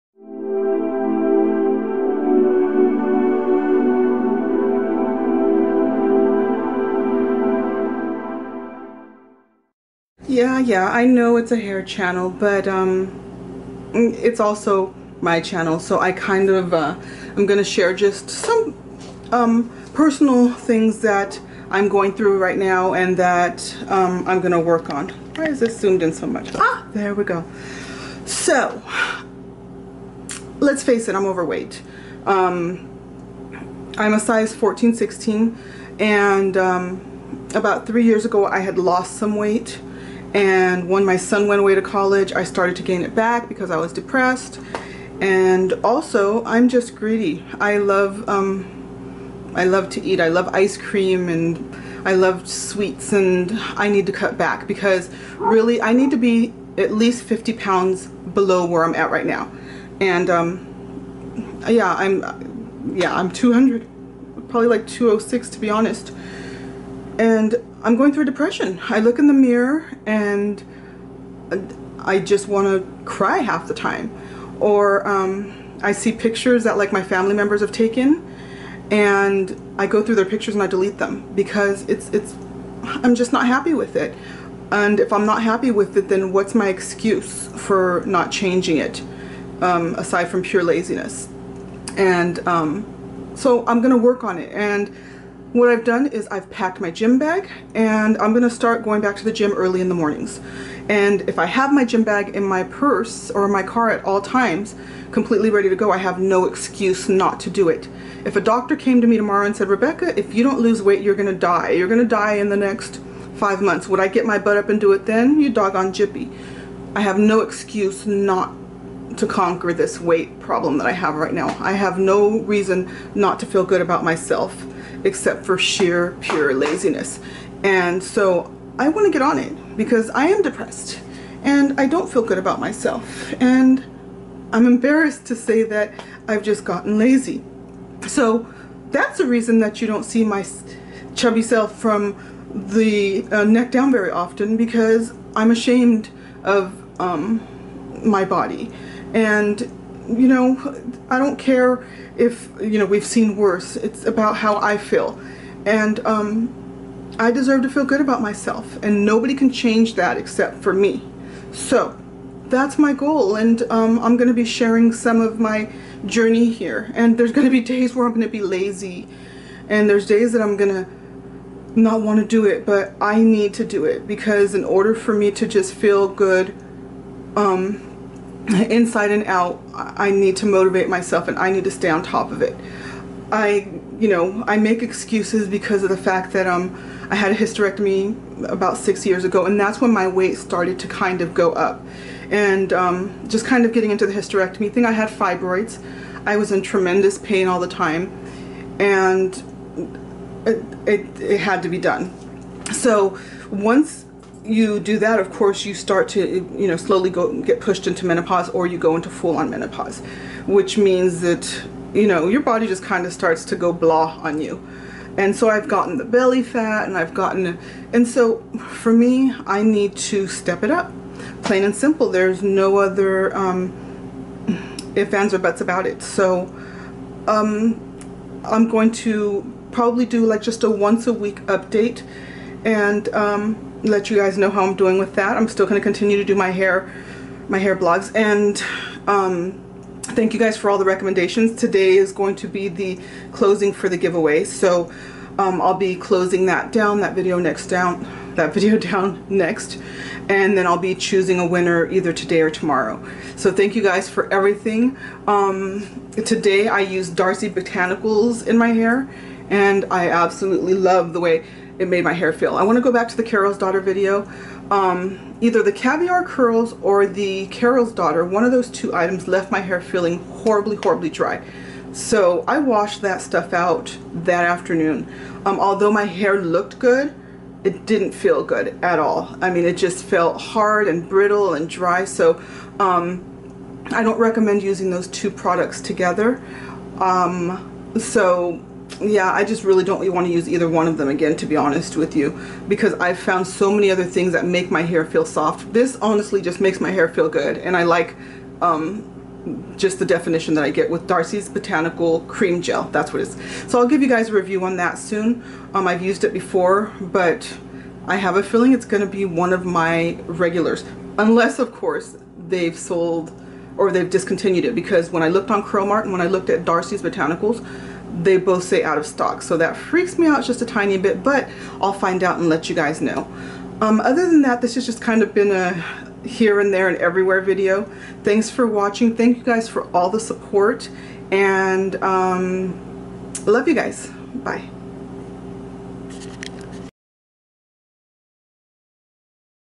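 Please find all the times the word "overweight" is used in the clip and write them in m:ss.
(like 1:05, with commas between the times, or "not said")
0:31.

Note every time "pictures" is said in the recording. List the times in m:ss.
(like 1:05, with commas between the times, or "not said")
1:16, 1:20.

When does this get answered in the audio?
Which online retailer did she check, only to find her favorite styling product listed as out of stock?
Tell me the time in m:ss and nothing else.
5:15.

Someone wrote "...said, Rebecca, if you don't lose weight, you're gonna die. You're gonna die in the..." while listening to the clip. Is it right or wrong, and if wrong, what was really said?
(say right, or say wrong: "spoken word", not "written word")
right.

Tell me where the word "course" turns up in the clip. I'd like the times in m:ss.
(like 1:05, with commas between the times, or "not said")
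3:25, 5:11.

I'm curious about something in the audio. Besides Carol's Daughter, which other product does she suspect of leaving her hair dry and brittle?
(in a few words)
Caviar curls.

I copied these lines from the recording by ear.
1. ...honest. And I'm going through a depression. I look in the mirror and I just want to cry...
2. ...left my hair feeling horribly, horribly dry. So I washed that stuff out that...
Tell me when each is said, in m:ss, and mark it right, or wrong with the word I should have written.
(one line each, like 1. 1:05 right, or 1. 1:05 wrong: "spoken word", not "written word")
1. 1:05 right
2. 4:29 right.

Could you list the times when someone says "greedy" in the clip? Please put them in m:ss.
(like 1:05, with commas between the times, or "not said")
0:46.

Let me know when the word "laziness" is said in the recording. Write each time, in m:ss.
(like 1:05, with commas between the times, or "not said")
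1:30, 2:06.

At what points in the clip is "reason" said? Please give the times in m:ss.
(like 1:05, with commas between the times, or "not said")
2:02, 2:19.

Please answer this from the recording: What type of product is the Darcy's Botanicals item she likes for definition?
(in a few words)
Cream Gel.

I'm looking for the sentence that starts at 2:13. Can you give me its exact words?
And I'm embarrassed to say that I've just gotten lazy.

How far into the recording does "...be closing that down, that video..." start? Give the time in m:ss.
4:05.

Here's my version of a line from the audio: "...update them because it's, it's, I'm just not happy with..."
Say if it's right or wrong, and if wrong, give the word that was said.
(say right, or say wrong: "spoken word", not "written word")
wrong: "delete", not "update".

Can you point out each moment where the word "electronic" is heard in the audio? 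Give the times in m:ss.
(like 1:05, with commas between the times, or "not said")
not said.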